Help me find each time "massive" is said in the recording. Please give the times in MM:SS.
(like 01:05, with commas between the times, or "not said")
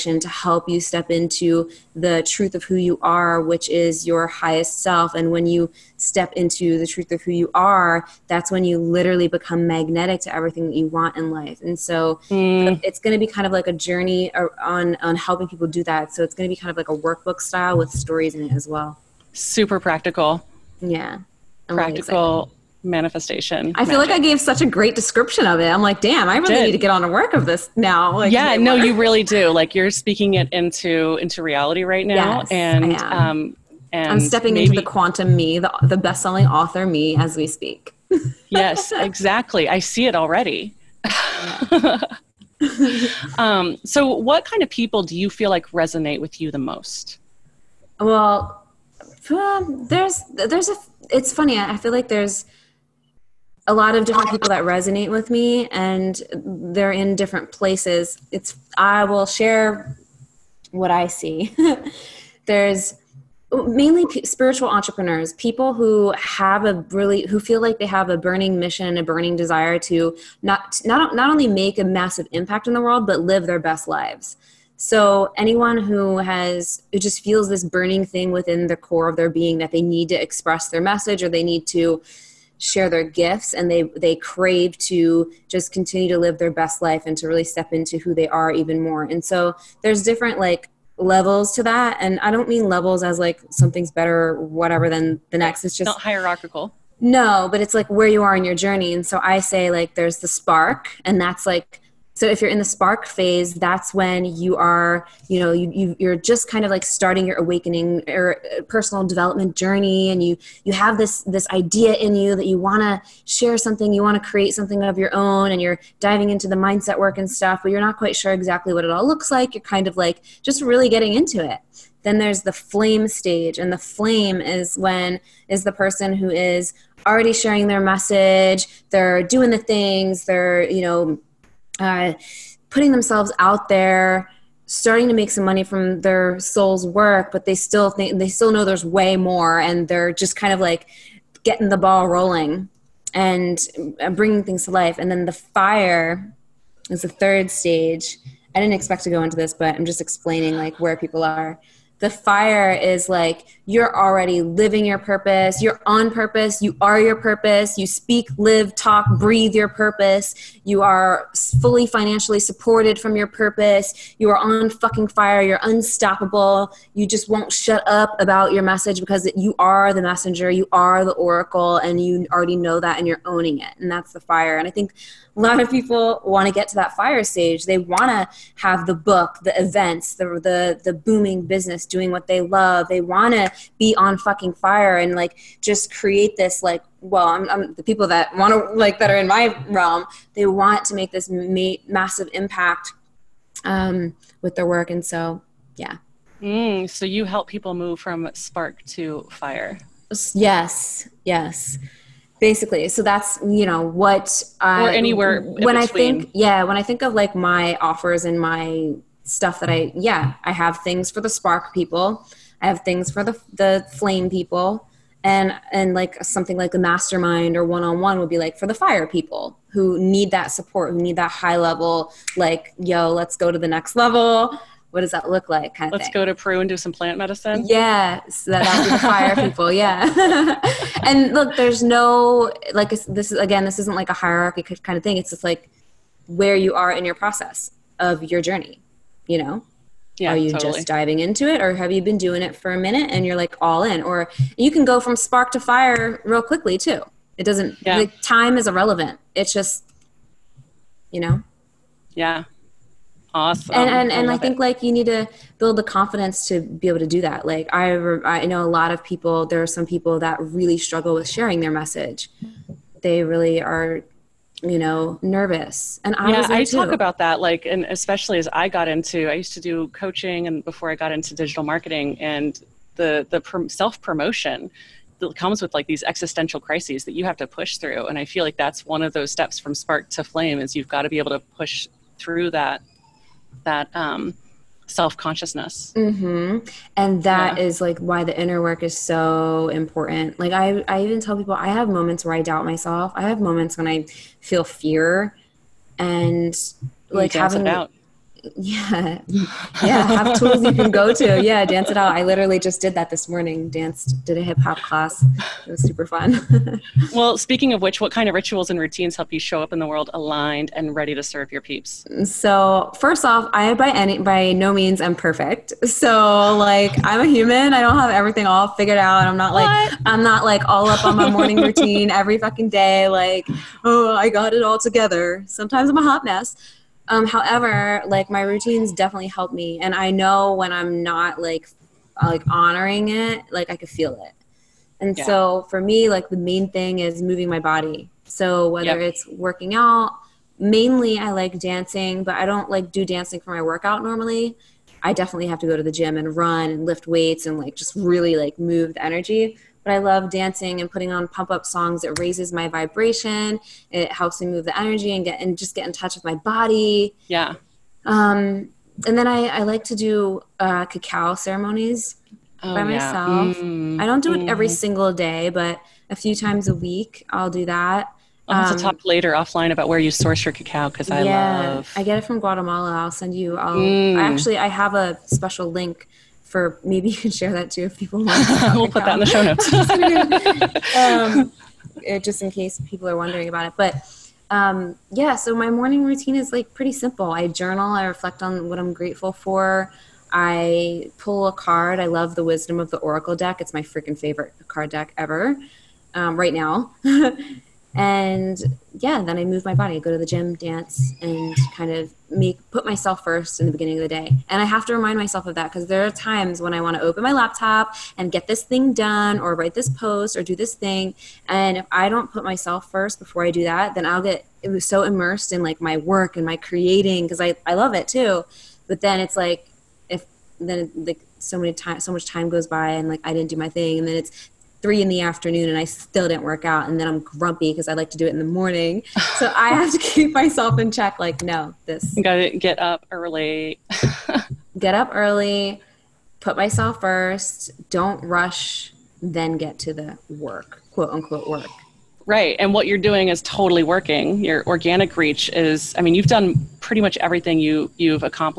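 01:11, 03:11.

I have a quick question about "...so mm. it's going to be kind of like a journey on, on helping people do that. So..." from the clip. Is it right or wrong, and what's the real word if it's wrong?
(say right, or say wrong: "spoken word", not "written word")
right.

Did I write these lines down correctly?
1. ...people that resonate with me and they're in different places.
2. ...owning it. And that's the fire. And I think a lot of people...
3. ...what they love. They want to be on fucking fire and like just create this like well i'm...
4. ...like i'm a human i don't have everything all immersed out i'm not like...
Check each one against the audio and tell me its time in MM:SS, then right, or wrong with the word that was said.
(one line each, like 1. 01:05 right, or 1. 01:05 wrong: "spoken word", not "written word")
1. 00:54 right
2. 02:53 right
3. 03:02 right
4. 05:16 wrong: "figured", not "immersed".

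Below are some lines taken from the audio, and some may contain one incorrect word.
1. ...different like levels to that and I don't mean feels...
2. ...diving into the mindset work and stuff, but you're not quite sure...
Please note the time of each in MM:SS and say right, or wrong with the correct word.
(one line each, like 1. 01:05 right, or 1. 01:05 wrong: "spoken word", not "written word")
1. 01:30 wrong: "levels", not "feels"
2. 01:55 right.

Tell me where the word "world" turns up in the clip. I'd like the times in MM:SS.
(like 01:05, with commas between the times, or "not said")
01:12, 05:09.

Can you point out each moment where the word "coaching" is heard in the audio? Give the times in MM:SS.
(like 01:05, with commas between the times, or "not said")
04:29.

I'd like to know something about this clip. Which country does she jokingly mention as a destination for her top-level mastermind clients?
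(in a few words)
Peru.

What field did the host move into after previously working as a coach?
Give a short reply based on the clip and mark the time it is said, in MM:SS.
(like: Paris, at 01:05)
Digital marketing, at 04:31.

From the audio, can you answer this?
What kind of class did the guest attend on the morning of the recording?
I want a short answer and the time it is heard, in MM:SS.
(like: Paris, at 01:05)
Hip-hop class, at 05:04.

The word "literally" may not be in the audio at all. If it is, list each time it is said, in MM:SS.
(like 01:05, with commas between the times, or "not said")
00:08, 05:02.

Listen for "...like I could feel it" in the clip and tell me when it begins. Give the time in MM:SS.
05:33.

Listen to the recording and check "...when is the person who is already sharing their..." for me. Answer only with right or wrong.
right.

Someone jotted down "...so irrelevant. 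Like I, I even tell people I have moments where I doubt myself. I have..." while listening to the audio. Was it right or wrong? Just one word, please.
wrong.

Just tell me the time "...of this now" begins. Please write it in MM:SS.
00:27.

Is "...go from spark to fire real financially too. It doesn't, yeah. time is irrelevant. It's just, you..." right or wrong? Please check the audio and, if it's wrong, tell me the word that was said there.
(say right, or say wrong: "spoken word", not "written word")
wrong: "quickly", not "financially".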